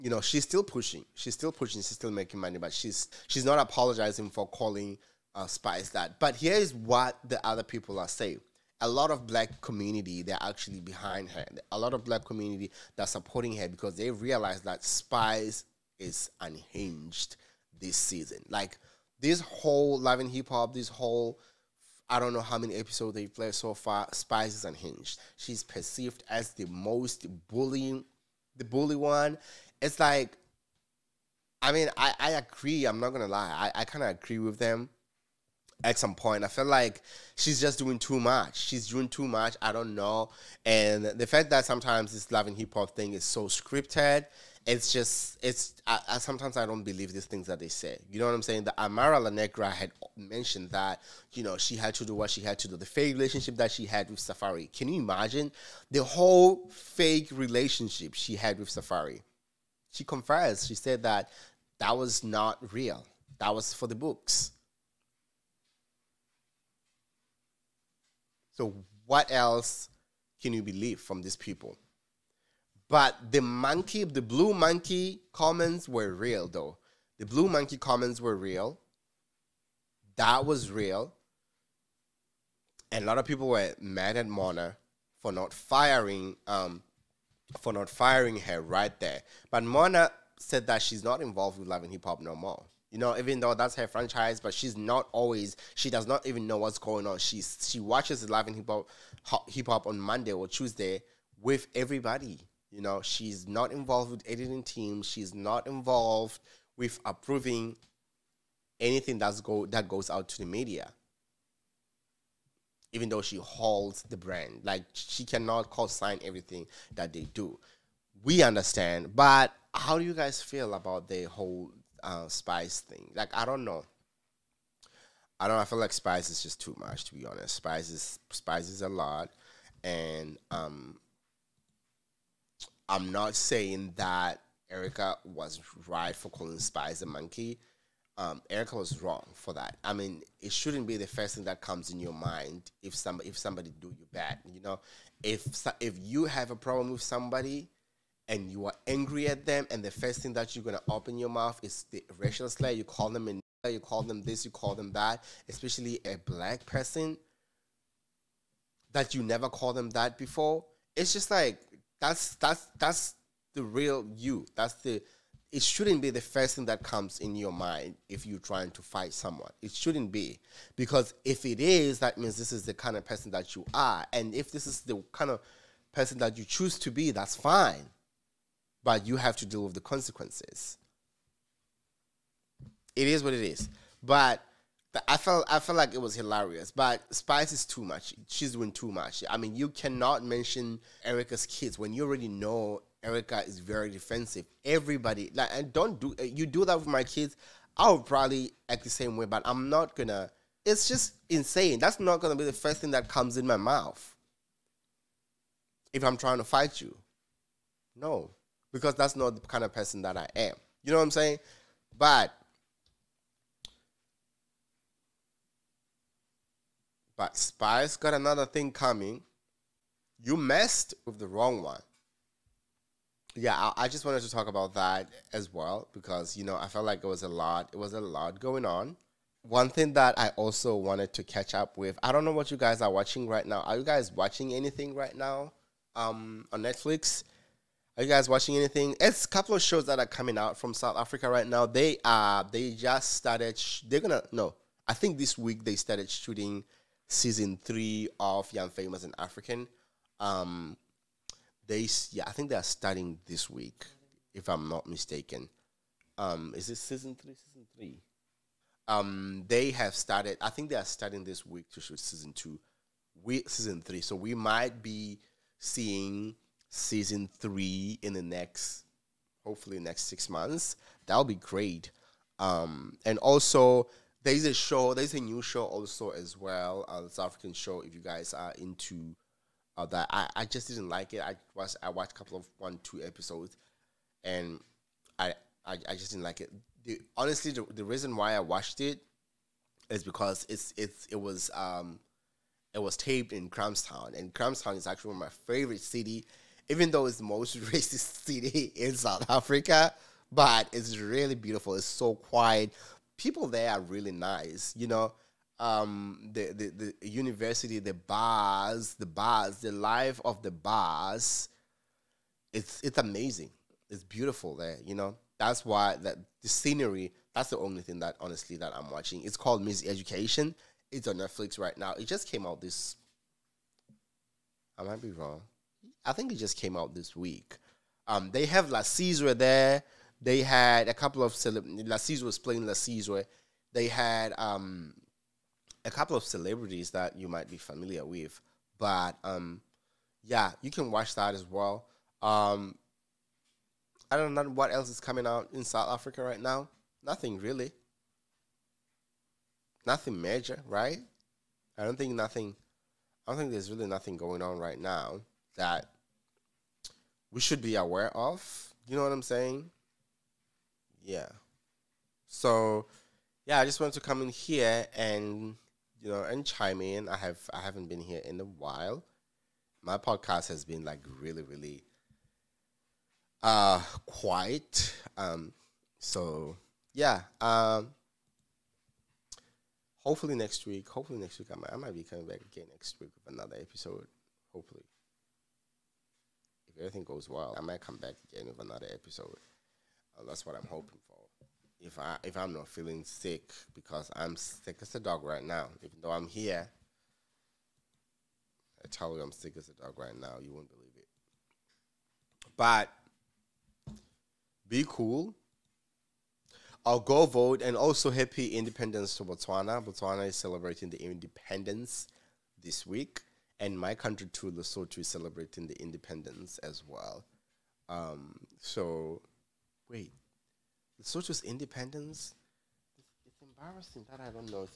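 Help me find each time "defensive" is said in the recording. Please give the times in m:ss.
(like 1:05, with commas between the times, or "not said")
3:13.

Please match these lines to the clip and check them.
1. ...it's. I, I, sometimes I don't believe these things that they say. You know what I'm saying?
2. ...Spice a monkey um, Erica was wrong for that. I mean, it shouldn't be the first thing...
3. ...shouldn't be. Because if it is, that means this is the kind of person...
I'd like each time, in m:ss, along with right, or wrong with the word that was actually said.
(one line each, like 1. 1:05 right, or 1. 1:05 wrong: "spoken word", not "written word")
1. 0:45 right
2. 2:16 right
3. 2:49 right.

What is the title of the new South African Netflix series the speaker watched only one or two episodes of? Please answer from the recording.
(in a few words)
Miseducation.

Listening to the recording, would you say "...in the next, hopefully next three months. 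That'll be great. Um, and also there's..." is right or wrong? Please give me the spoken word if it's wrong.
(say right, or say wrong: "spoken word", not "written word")
wrong: "six", not "three".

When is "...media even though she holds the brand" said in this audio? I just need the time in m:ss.
1:50.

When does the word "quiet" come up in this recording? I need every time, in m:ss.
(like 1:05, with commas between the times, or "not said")
5:02, 6:14.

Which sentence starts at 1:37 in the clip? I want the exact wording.
She's she watches Love and Hip Hop Hip Hop on Monday or Tuesday with everybody.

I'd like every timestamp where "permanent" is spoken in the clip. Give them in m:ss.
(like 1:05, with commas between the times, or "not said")
not said.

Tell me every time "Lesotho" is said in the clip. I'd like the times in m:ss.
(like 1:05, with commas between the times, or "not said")
6:54, 7:01.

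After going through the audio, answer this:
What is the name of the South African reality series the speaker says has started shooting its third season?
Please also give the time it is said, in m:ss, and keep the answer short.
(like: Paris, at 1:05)
Young Famous and African, at 4:08.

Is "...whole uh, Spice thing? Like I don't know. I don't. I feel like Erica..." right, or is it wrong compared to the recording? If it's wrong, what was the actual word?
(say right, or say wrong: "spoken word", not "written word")
wrong: "Spice", not "Erica".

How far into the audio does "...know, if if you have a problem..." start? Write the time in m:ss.
2:24.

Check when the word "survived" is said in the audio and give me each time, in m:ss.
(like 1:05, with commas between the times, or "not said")
not said.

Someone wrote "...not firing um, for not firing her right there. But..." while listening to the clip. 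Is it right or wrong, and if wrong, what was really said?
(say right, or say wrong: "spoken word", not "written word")
right.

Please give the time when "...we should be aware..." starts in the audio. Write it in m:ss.
5:57.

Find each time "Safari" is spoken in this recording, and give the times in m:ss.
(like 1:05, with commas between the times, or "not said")
0:54, 0:58.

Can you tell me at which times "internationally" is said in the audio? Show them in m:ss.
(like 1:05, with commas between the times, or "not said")
not said.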